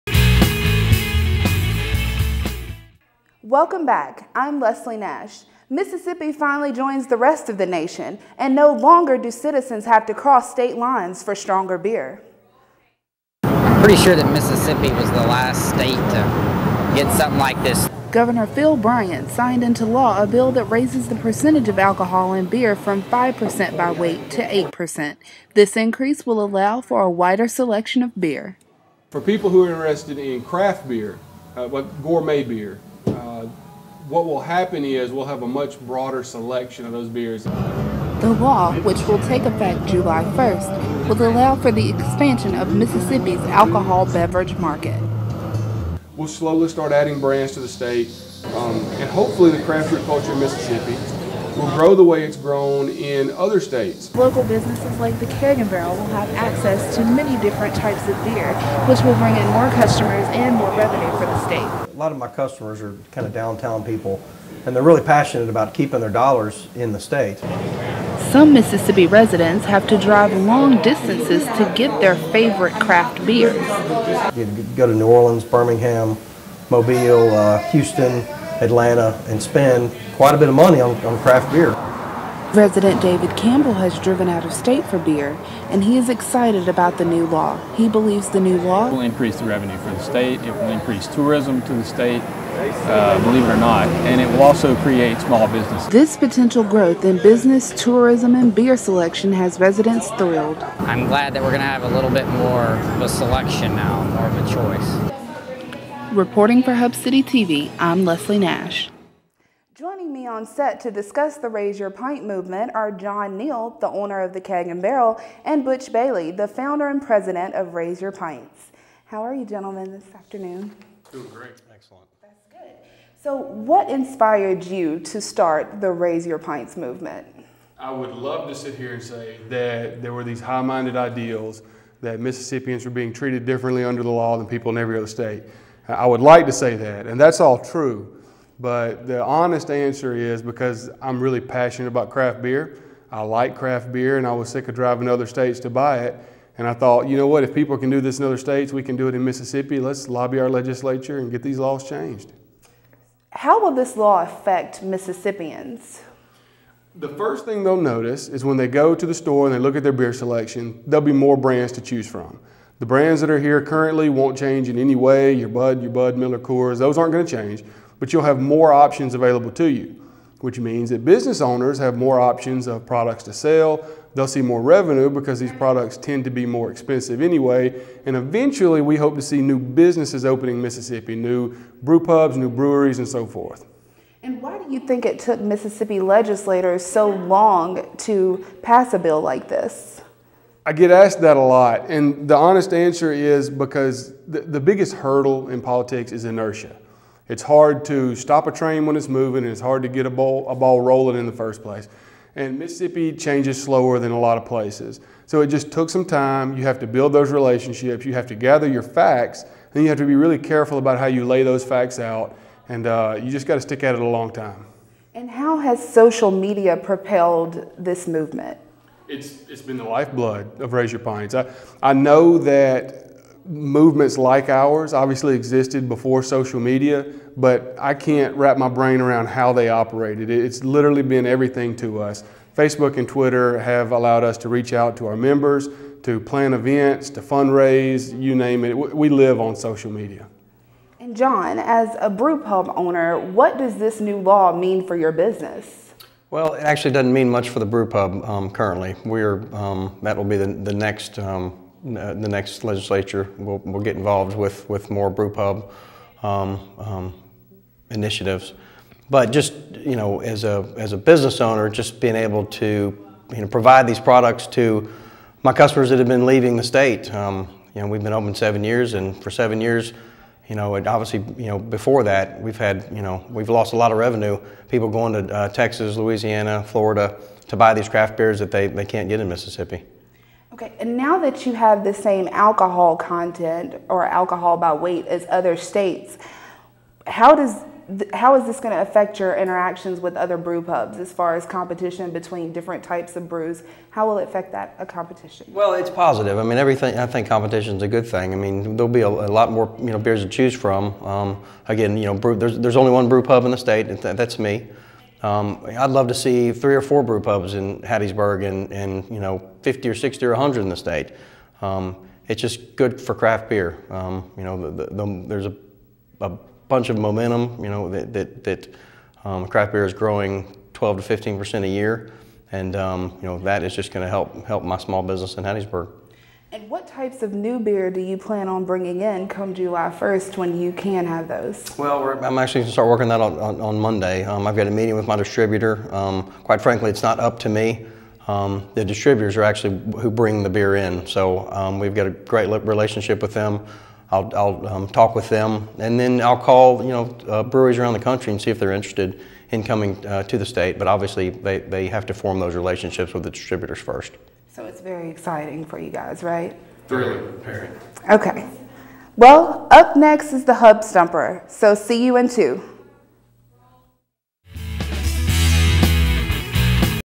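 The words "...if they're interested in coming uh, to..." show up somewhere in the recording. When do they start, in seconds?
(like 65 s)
348 s.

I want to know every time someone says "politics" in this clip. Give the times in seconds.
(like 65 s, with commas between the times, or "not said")
195 s.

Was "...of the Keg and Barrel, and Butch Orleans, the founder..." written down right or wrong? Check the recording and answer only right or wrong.
wrong.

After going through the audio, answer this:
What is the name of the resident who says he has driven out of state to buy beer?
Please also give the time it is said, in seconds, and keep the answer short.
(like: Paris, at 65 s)
David Campbell, at 83 s.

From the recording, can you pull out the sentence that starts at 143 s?
I like craft beer and I was sick of driving to other states to buy it.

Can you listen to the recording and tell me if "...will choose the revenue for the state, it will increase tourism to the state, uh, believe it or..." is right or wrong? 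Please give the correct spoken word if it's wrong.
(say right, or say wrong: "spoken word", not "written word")
wrong: "increase", not "choose".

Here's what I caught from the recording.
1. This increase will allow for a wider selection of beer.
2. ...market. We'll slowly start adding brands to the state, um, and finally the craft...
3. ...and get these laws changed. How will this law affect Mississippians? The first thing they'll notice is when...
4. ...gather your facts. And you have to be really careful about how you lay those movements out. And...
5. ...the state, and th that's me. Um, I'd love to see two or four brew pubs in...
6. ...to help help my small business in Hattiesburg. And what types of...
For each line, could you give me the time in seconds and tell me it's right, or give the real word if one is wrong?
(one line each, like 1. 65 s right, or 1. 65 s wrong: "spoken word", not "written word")
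1. 25 s right
2. 44 s wrong: "hopefully", not "finally"
3. 151 s right
4. 208 s wrong: "facts", not "movements"
5. 303 s wrong: "three", not "two"
6. 324 s right.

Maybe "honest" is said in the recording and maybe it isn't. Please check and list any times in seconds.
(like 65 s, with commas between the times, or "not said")
139 s, 192 s.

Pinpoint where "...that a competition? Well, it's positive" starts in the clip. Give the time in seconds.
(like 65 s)
294 s.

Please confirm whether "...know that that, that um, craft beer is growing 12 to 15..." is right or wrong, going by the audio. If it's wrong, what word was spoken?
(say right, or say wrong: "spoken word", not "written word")
right.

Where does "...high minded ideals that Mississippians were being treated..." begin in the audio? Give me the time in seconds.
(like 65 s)
130 s.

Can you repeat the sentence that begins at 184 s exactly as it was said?
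And why do you think it took Mississippi legislators so long to pass a bill like this?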